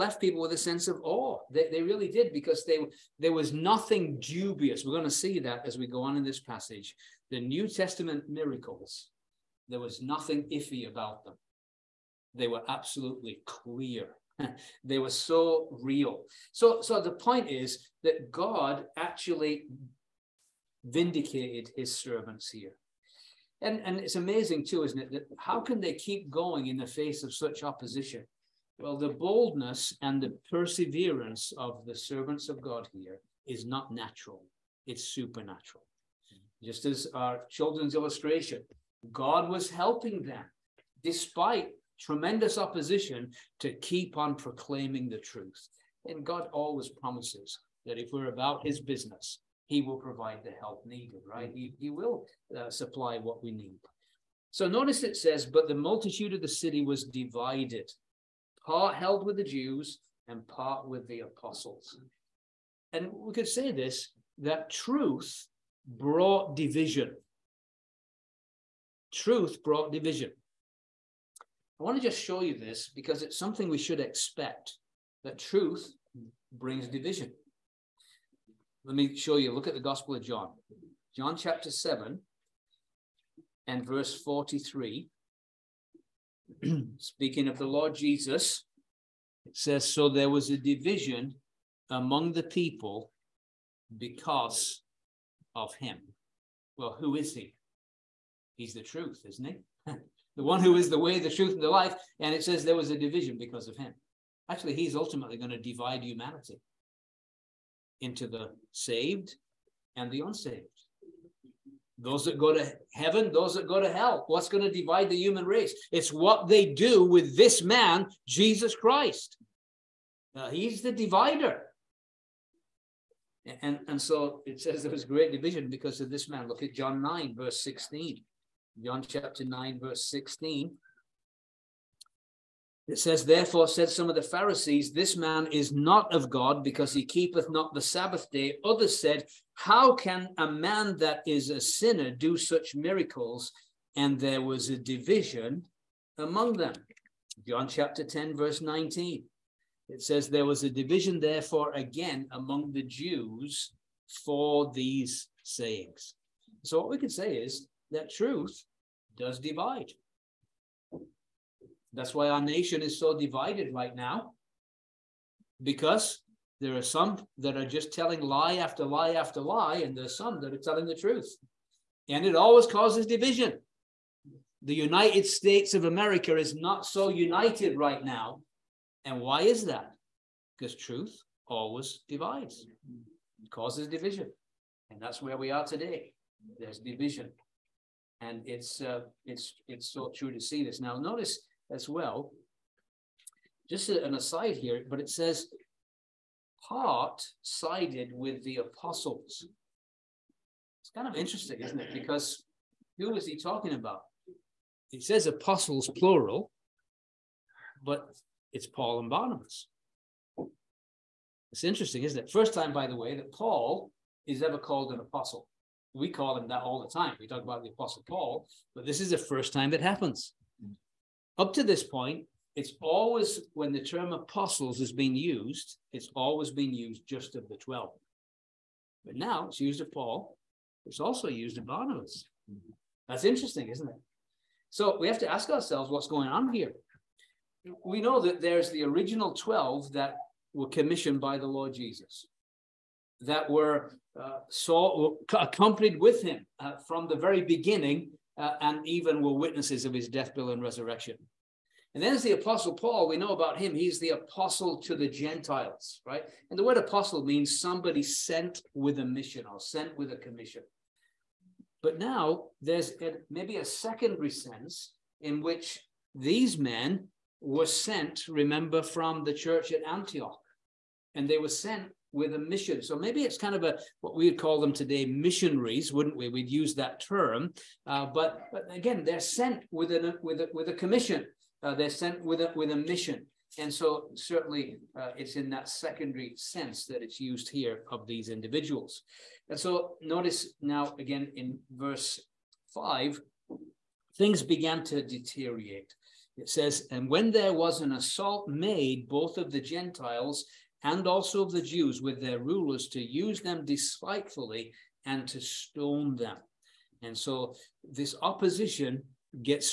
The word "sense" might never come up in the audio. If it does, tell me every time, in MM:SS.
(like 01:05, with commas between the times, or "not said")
00:00, 04:24, 04:46.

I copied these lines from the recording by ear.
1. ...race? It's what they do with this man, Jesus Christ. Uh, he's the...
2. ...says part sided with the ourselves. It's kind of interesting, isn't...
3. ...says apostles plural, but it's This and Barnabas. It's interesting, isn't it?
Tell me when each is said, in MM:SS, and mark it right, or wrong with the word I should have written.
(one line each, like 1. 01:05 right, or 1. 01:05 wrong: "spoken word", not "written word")
1. 01:55 right
2. 03:15 wrong: "apostles", not "ourselves"
3. 03:25 wrong: "Paul", not "This".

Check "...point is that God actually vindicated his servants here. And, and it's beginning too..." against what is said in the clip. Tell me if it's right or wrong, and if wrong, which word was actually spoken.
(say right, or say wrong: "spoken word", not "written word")
wrong: "amazing", not "beginning".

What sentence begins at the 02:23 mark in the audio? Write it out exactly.
And there was a division among them.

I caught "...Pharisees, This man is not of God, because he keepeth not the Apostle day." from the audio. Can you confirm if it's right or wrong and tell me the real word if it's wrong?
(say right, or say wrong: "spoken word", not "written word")
wrong: "Sabbath", not "Apostle".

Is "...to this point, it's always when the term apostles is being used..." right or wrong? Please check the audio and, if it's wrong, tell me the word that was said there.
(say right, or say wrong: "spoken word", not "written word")
right.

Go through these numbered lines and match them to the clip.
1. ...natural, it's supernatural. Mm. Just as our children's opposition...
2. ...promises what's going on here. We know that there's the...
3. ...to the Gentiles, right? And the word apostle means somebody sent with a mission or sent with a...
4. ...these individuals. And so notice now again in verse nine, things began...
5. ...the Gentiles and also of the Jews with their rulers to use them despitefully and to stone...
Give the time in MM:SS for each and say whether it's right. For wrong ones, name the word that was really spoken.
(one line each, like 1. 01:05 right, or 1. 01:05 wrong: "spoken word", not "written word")
1. 00:33 wrong: "illustration", not "opposition"
2. 03:55 wrong: "ourselves", not "promises"
3. 04:14 right
4. 04:48 wrong: "five", not "nine"
5. 04:59 right.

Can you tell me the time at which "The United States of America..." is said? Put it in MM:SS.
02:54.